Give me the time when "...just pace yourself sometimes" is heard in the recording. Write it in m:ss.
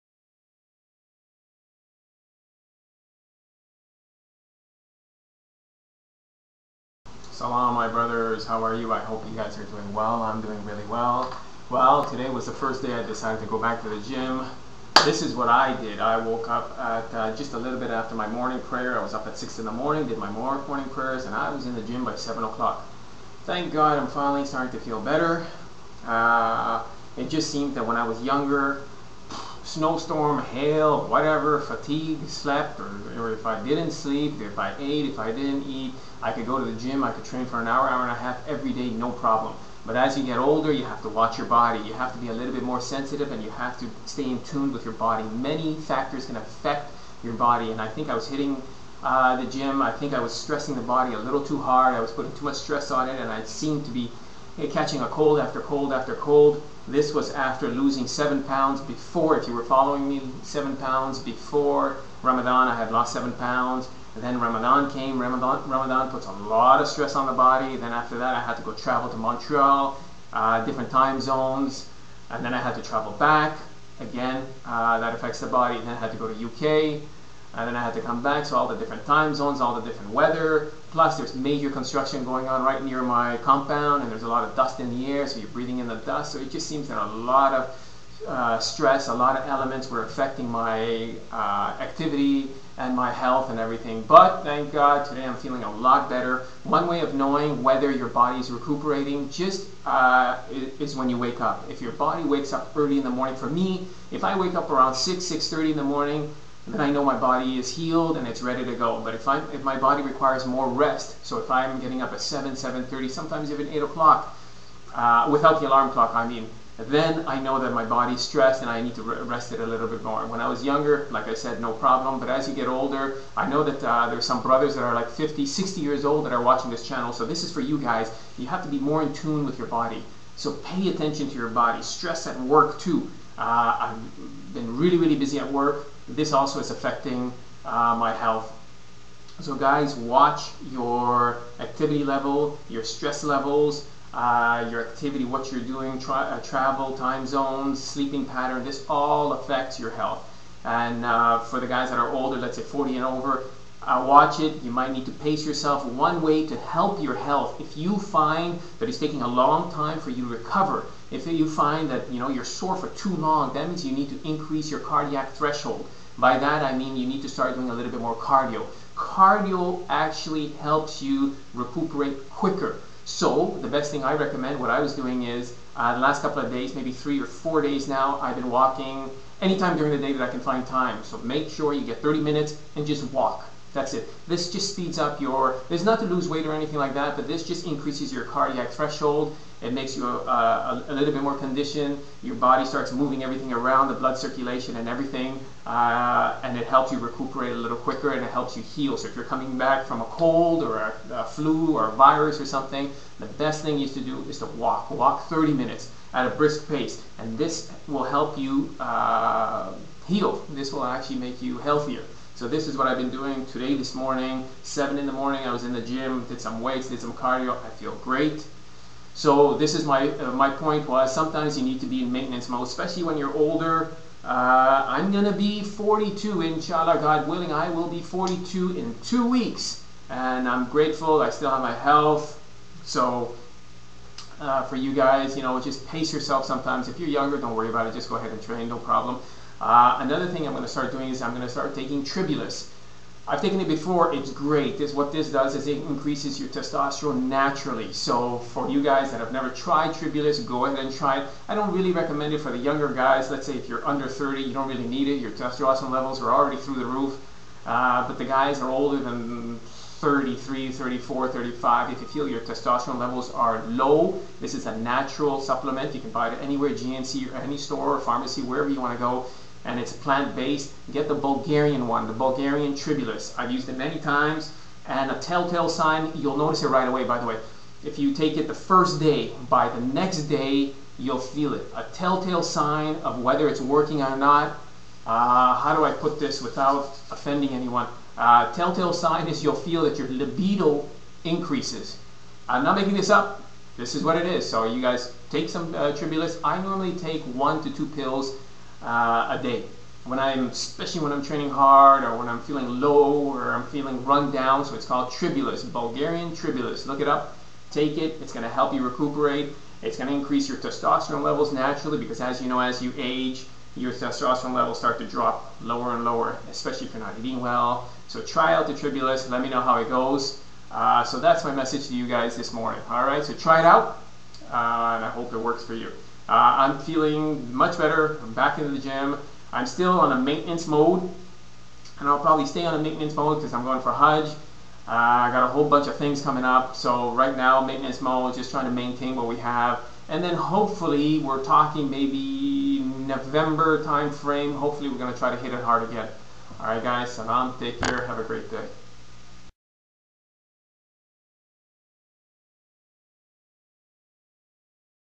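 3:55.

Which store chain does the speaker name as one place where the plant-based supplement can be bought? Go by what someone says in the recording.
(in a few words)
GNC.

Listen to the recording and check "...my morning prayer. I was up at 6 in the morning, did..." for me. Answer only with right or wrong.
right.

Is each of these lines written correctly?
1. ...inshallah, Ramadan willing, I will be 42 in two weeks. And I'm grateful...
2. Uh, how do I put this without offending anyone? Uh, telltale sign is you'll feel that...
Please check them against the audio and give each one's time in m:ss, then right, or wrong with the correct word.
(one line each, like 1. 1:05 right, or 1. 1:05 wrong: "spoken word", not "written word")
1. 3:46 wrong: "God", not "Ramadan"
2. 4:45 right.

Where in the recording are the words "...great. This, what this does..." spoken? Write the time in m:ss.
4:04.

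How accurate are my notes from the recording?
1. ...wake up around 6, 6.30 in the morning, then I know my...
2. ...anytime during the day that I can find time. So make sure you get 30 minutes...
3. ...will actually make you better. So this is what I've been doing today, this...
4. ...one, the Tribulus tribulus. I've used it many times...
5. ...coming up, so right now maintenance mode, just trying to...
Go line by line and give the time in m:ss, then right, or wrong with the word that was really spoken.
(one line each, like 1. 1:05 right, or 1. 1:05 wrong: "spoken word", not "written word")
1. 1:44 right
2. 2:59 right
3. 3:30 wrong: "healthier", not "better"
4. 4:31 wrong: "Bulgarian", not "Tribulus"
5. 5:36 right.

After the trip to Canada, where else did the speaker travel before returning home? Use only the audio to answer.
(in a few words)
UK.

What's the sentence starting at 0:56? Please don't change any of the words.
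This was after losing seven pounds before, if you were following me, seven pounds before Ramadan.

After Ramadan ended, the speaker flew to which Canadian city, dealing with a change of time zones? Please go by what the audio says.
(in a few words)
Montreal.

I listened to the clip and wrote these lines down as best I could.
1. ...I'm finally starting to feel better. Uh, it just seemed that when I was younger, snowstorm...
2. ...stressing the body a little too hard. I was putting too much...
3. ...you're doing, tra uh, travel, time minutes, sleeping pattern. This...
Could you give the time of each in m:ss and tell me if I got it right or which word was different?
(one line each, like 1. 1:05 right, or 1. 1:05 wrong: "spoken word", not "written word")
1. 0:23 right
2. 0:50 right
3. 2:25 wrong: "zones", not "minutes".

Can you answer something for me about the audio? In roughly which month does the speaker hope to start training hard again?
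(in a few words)
November.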